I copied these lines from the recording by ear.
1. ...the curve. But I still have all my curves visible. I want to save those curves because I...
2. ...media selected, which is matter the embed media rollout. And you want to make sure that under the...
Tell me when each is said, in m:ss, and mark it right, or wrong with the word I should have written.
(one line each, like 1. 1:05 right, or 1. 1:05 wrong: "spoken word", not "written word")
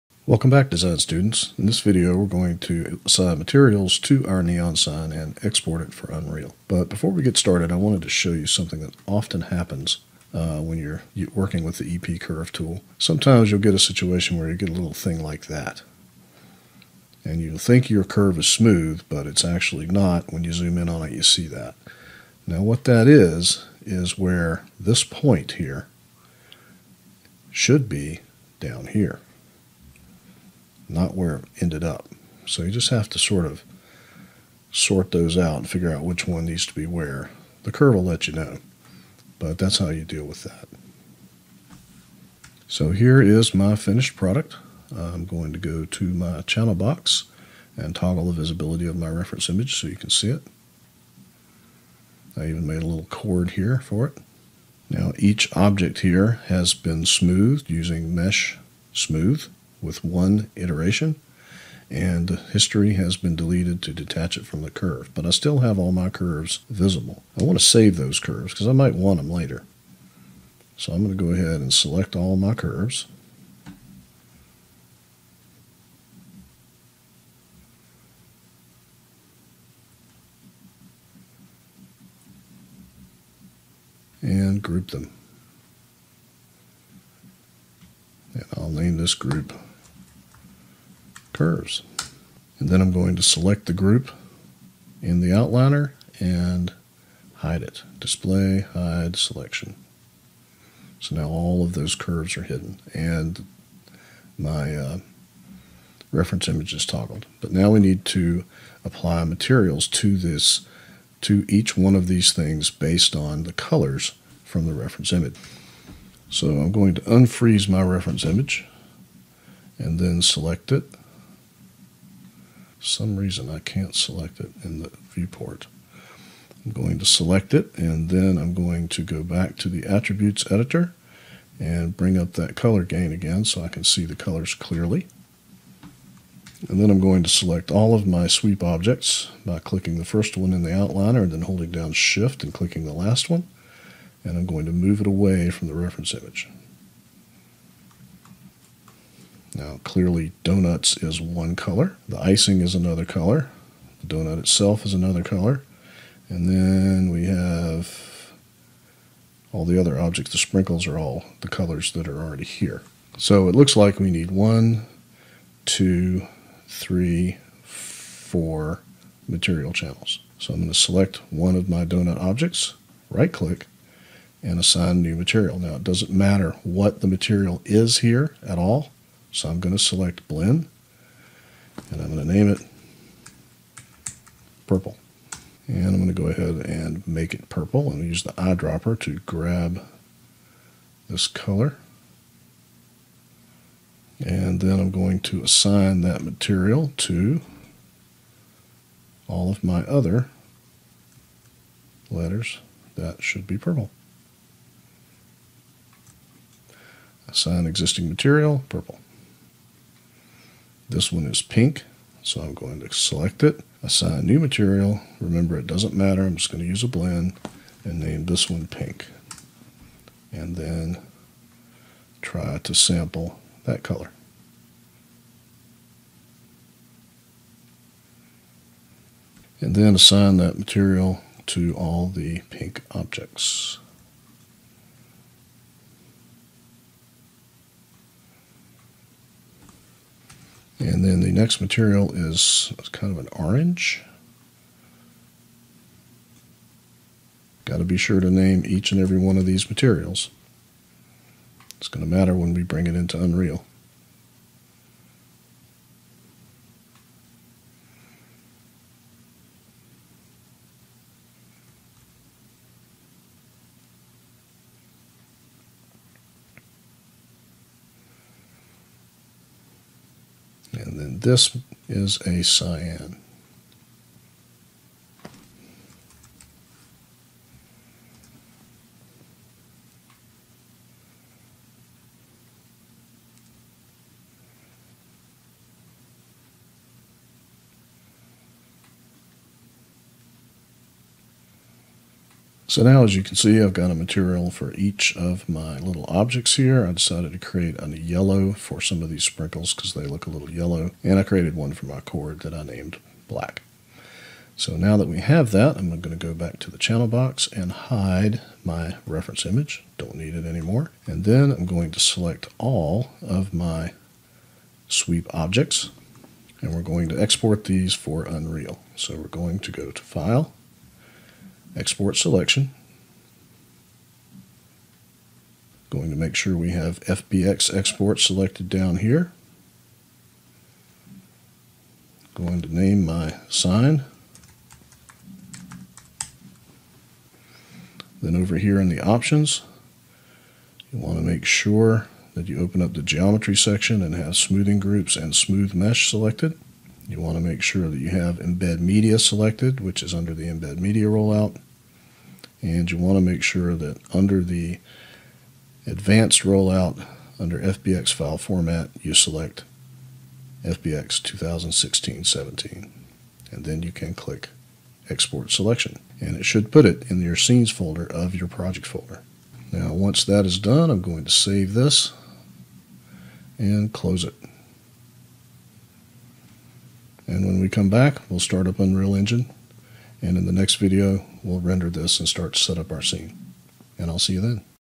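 1. 1:04 right
2. 5:48 wrong: "under", not "matter".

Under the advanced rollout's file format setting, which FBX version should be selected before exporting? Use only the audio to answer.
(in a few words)
FBX 2016-17.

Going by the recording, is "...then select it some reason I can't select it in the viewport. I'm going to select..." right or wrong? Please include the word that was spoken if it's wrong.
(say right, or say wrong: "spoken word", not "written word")
right.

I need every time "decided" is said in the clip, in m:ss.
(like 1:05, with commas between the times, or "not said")
4:56.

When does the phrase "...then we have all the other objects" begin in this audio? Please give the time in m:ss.
2:36.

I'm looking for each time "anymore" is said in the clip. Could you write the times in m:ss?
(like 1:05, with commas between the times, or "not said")
5:10.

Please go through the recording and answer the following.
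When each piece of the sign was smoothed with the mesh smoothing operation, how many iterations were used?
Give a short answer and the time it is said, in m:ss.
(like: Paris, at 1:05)
1, at 1:00.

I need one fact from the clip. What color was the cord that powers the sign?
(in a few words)
black.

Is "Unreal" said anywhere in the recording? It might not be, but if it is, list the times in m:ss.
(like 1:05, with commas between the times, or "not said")
0:06, 4:13, 5:18, 6:18.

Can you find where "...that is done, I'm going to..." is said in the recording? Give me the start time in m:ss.
6:10.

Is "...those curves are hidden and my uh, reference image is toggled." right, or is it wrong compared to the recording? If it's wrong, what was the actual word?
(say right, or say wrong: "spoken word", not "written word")
right.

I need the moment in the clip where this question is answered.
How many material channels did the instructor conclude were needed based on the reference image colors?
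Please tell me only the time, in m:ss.
2:47.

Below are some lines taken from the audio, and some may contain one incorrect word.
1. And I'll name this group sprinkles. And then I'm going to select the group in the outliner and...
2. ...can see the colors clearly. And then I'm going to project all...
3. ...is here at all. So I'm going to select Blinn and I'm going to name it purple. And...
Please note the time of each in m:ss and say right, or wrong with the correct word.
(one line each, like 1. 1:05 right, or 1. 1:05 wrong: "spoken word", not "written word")
1. 1:28 wrong: "curves", not "sprinkles"
2. 2:13 wrong: "select", not "project"
3. 2:57 right.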